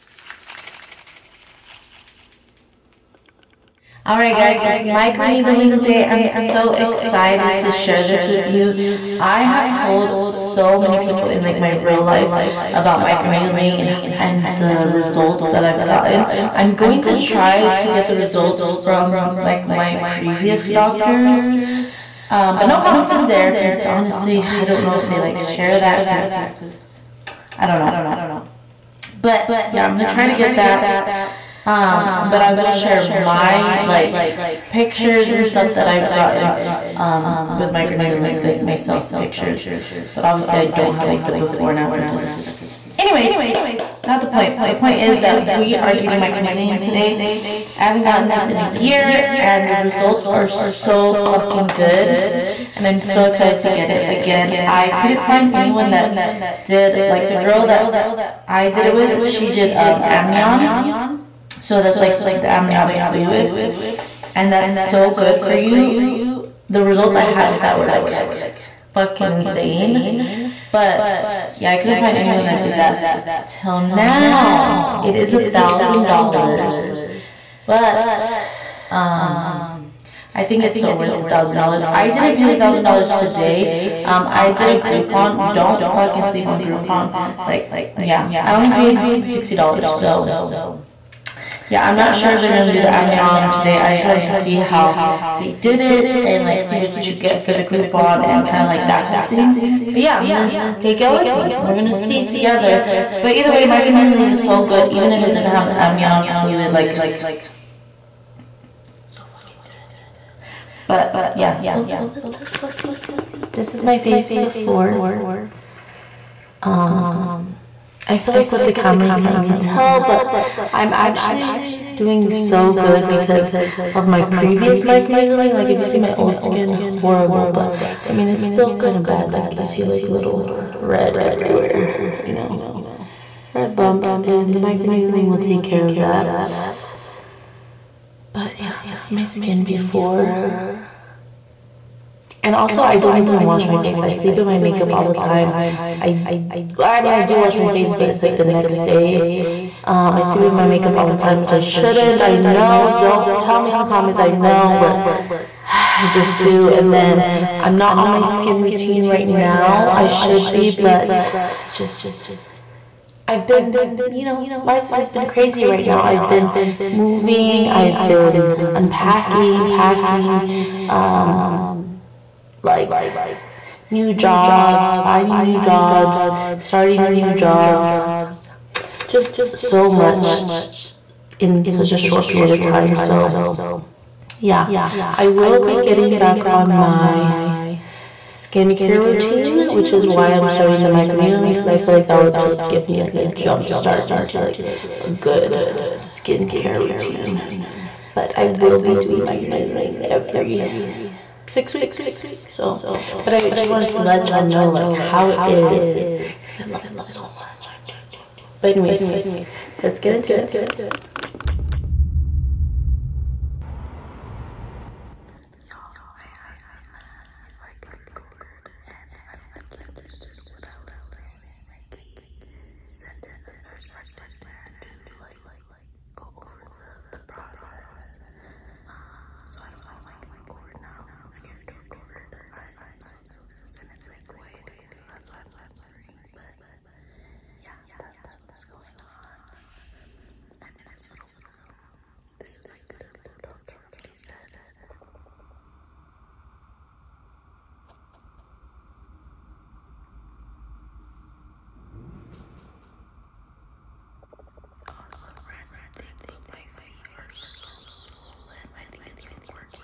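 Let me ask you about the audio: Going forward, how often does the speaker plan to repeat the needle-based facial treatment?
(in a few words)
every 6 weeks.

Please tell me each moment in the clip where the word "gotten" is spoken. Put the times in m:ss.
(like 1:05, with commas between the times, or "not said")
0:15, 0:36, 0:48.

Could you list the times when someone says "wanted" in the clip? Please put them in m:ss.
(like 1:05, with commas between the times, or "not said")
1:34, 3:23.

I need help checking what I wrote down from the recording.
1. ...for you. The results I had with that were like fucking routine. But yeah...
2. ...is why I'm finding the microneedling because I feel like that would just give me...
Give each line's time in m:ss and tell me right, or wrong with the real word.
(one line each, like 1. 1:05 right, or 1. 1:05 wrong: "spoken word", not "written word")
1. 1:05 wrong: "insane", not "routine"
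2. 3:09 wrong: "starting", not "finding".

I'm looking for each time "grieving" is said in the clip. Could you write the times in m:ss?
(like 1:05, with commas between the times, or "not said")
not said.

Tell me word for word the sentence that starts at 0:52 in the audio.
And I'm so excited to get it again.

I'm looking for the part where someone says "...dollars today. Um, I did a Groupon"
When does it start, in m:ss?
1:22.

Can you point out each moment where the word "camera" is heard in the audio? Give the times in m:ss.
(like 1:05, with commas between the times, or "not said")
1:58.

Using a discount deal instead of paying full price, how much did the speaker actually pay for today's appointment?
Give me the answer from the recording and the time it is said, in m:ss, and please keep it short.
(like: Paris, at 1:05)
$60, at 1:29.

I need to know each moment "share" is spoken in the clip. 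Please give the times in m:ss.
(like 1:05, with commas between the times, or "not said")
0:07, 0:25, 0:32.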